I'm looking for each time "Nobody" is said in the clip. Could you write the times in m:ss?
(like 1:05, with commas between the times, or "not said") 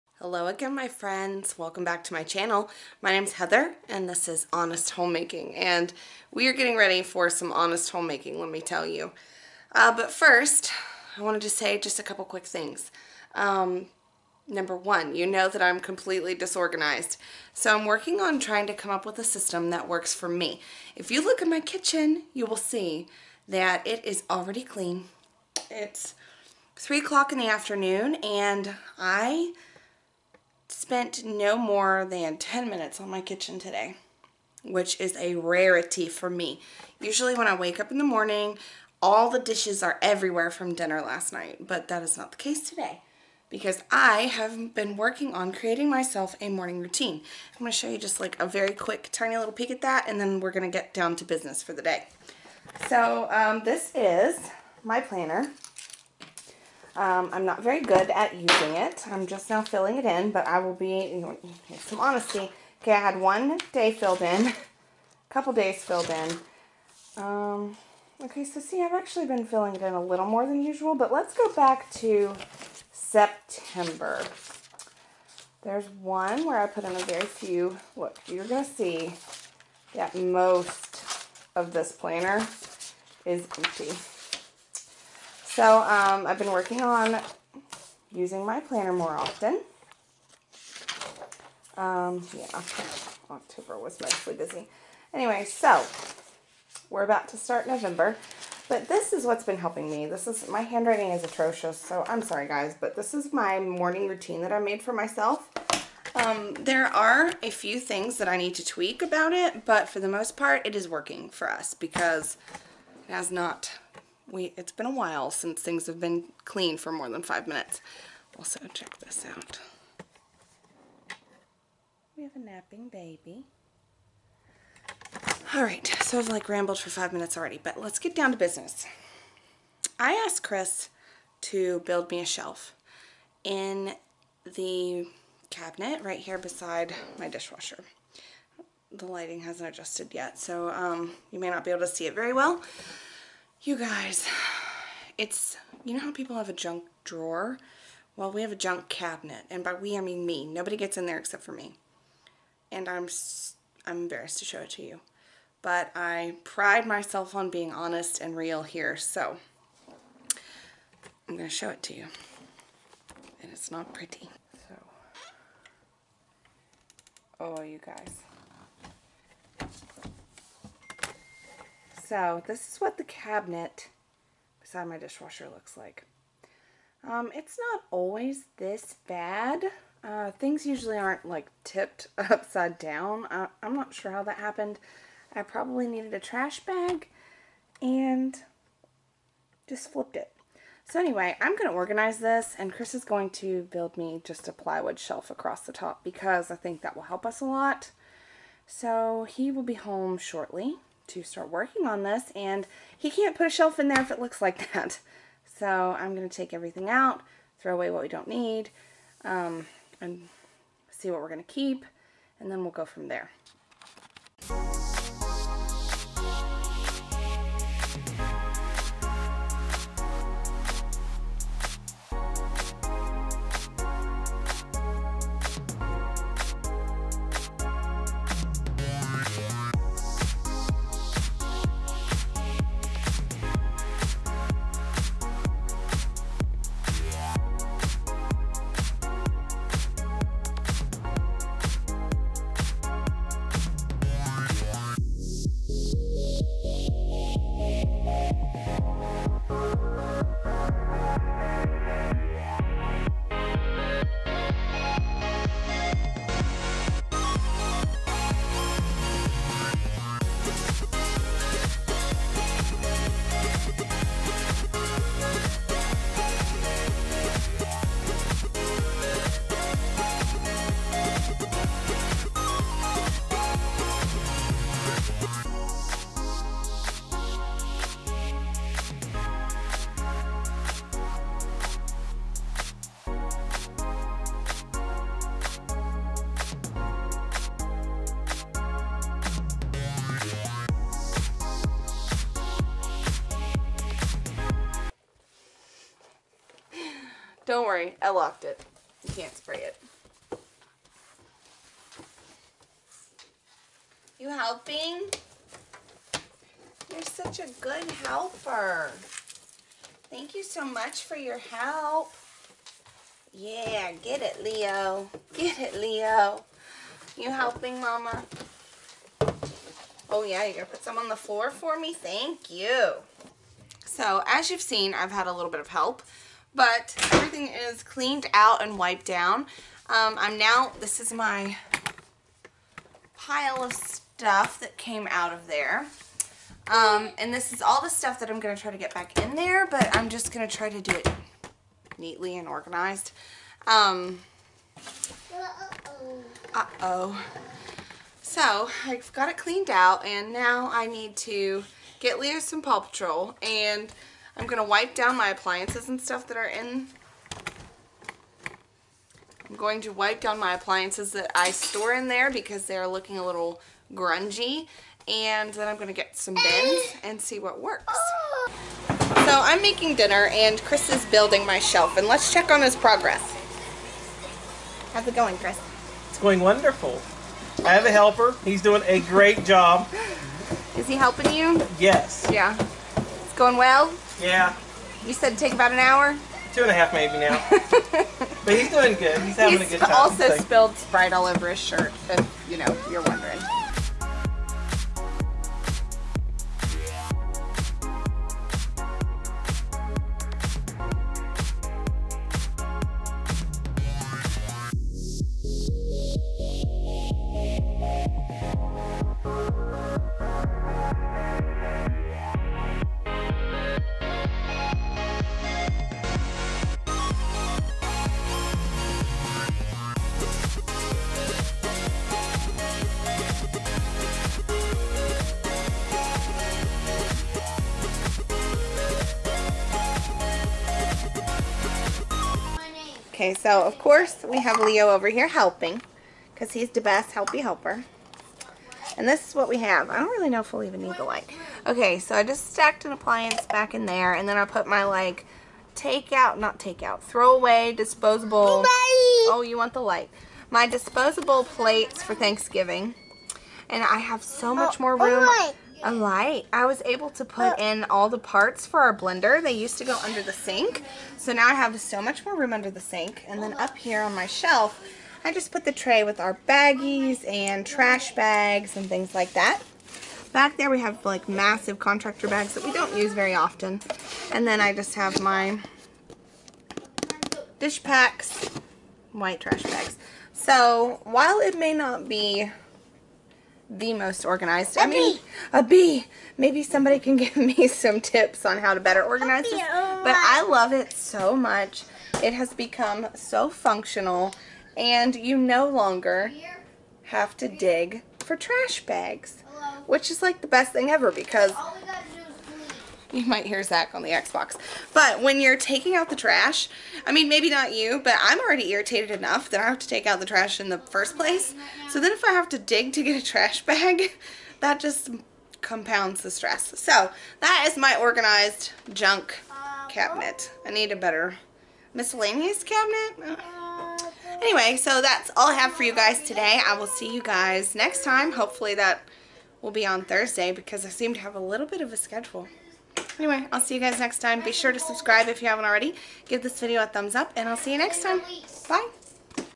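2:30.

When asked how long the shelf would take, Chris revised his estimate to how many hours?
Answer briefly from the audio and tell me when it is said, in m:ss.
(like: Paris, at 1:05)
2.5, at 6:26.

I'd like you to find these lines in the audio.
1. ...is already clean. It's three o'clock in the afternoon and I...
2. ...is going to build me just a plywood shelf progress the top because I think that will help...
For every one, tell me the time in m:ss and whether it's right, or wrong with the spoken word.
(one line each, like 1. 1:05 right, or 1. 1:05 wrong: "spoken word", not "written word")
1. 0:24 right
2. 3:12 wrong: "across", not "progress".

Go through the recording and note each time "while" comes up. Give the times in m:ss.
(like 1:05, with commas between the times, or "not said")
1:54, 8:01.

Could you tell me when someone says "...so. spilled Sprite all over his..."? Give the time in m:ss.
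6:30.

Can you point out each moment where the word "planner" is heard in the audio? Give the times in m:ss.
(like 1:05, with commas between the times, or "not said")
0:55, 1:21, 1:28.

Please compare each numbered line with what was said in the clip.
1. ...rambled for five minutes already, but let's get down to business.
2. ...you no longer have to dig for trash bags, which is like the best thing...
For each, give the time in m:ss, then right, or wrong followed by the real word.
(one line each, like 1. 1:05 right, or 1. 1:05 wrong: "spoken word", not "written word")
1. 2:06 right
2. 8:15 right.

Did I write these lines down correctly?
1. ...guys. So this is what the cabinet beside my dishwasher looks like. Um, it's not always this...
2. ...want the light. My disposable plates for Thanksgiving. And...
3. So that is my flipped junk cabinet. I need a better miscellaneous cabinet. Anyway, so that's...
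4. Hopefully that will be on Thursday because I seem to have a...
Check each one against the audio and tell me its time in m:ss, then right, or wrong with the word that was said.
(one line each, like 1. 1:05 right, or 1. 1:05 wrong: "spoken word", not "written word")
1. 2:47 right
2. 7:29 right
3. 8:36 wrong: "organized", not "flipped"
4. 8:48 right.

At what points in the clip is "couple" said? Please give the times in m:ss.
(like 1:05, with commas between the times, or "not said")
0:12, 1:05.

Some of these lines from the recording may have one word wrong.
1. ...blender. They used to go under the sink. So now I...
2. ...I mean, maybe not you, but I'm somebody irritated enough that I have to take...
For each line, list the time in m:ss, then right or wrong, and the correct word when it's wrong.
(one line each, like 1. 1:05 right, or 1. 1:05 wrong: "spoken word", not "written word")
1. 7:38 right
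2. 8:27 wrong: "already", not "somebody".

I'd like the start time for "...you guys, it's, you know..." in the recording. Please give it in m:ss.
2:23.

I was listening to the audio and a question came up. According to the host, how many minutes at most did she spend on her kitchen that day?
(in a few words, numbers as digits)
10.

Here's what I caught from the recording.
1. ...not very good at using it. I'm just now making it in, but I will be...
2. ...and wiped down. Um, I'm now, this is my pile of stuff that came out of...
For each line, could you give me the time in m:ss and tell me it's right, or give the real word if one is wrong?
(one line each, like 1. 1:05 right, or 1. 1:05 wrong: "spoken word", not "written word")
1. 0:57 wrong: "filling", not "making"
2. 5:28 right.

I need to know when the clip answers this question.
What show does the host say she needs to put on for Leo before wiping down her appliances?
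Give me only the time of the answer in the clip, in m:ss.
5:52.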